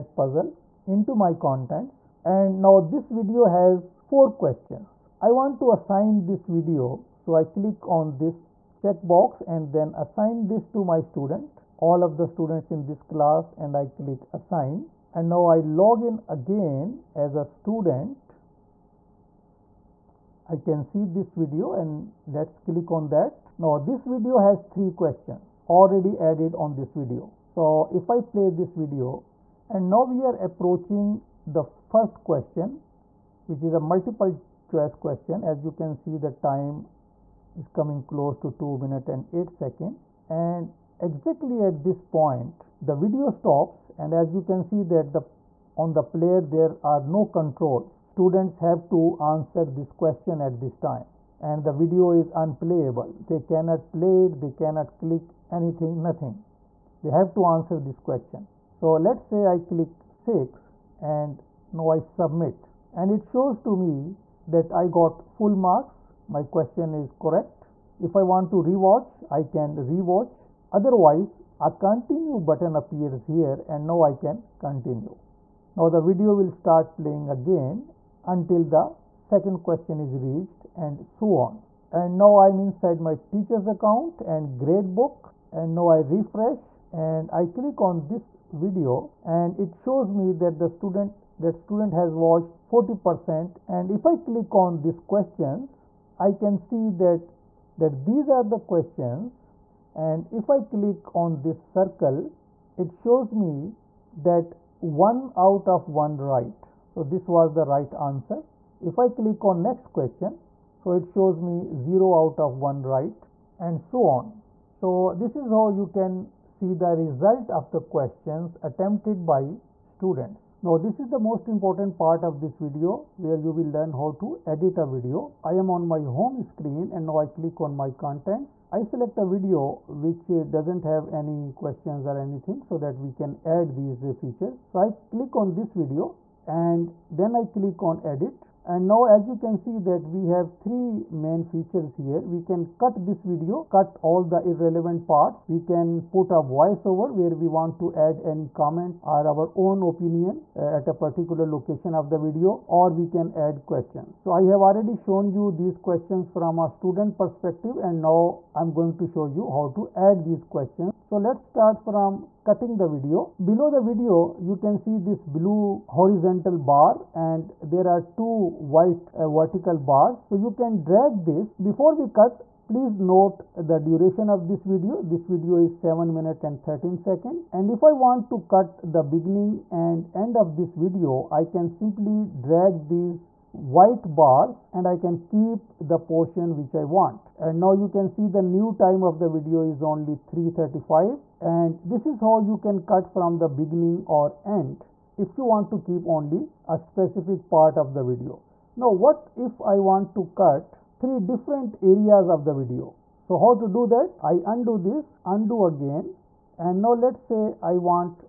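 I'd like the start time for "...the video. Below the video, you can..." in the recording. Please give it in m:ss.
2:42.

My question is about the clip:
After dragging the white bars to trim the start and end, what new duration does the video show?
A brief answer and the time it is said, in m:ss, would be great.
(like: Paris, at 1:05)
3:35, at 3:10.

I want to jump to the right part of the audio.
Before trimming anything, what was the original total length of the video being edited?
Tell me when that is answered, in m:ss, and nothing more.
2:55.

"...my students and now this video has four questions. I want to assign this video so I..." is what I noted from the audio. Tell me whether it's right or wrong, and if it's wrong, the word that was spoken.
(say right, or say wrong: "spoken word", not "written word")
wrong: "contents", not "students".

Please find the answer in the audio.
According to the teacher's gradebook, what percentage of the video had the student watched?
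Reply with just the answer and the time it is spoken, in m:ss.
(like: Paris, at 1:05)
40%, at 1:32.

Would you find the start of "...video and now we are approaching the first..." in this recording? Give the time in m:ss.
0:28.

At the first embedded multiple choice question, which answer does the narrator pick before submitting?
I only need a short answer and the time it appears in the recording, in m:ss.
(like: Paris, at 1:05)
6, at 1:00.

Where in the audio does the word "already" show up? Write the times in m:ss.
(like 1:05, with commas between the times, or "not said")
0:25, 2:34.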